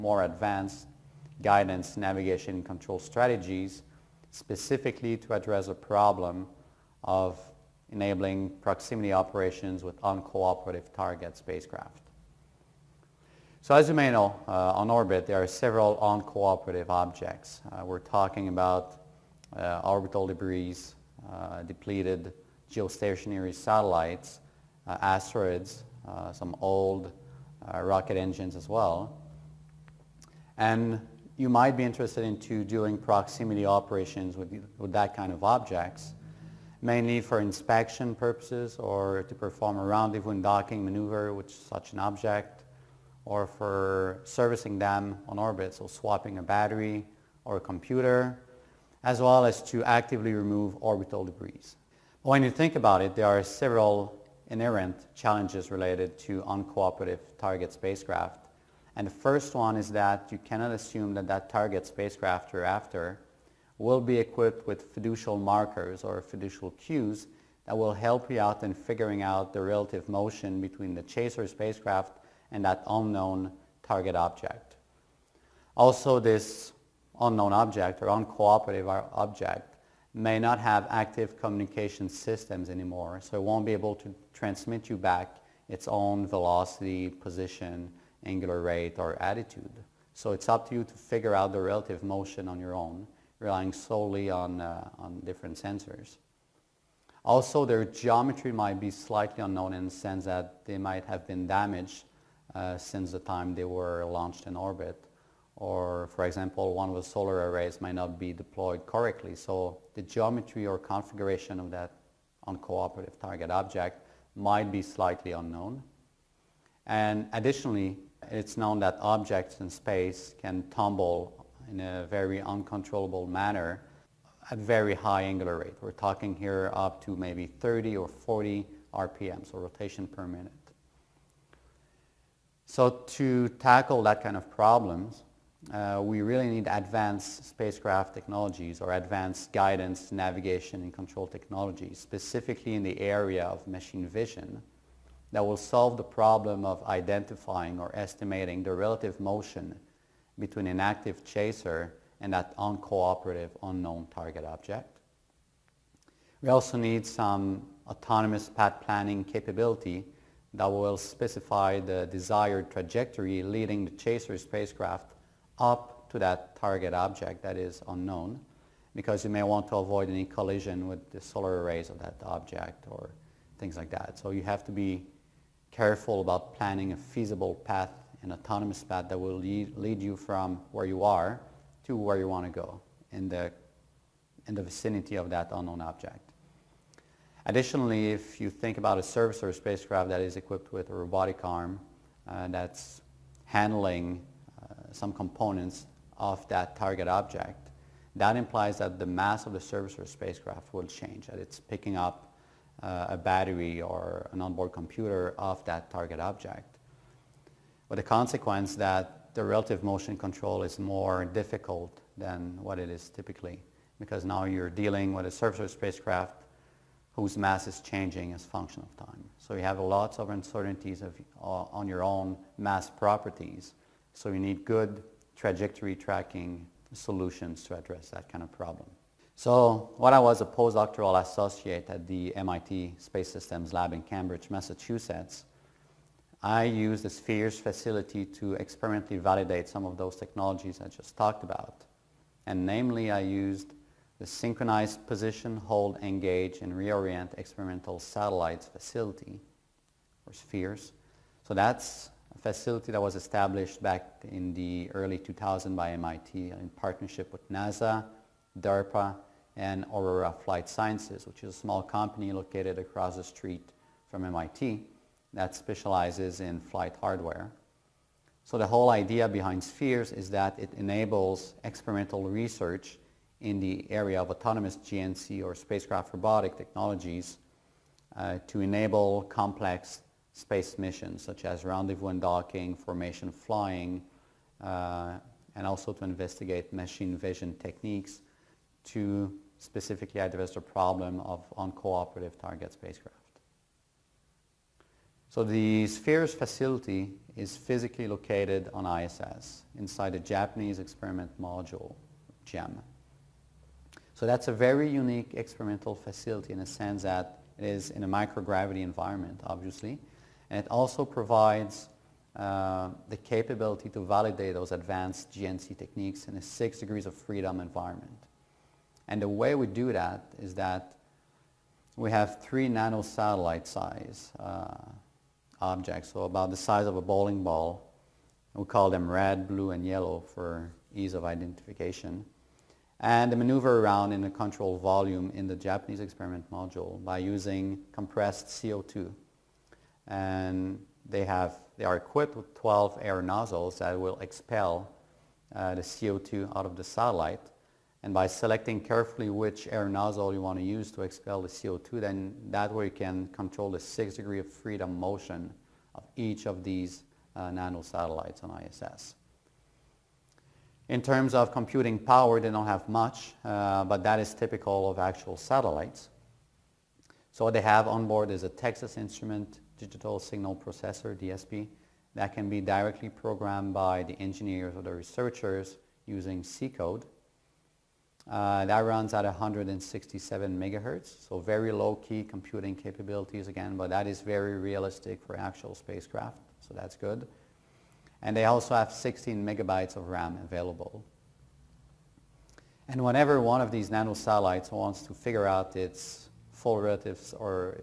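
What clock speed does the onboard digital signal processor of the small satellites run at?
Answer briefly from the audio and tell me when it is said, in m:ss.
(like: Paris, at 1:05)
167 megahertz, at 6:19.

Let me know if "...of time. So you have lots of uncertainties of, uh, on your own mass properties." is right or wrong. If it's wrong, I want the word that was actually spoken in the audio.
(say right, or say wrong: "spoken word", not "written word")
right.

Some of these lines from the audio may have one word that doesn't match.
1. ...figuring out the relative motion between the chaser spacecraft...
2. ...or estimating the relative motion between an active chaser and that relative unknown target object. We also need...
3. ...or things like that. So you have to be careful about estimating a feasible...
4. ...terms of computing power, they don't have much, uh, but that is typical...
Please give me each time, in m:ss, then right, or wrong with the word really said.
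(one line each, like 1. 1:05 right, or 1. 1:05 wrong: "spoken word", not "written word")
1. 1:08 right
2. 2:27 wrong: "uncooperative", not "relative"
3. 2:52 wrong: "planning", not "estimating"
4. 6:01 right.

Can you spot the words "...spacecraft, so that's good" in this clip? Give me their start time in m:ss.
6:25.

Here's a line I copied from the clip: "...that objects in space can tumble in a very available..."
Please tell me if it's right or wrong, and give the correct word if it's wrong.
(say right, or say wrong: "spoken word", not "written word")
wrong: "uncontrollable", not "available".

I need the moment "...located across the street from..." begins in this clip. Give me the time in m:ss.
4:22.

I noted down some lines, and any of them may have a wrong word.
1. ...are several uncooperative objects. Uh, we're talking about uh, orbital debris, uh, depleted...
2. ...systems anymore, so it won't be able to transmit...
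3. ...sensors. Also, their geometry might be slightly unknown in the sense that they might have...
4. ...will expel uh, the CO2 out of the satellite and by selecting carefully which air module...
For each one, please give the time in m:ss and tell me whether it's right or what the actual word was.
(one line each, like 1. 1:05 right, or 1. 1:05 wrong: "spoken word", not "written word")
1. 0:15 right
2. 1:22 right
3. 1:35 right
4. 5:43 wrong: "nozzle", not "module".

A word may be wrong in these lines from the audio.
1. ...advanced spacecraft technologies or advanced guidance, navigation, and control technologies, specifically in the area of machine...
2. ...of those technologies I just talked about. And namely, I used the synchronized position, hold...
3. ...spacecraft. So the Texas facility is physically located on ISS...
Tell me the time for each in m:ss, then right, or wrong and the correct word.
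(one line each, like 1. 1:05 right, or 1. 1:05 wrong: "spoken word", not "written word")
1. 2:16 right
2. 3:59 right
3. 4:52 wrong: "Spheres", not "Texas".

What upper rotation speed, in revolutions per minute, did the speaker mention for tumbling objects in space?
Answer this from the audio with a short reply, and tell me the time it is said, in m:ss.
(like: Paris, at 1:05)
40 RPM, at 2:08.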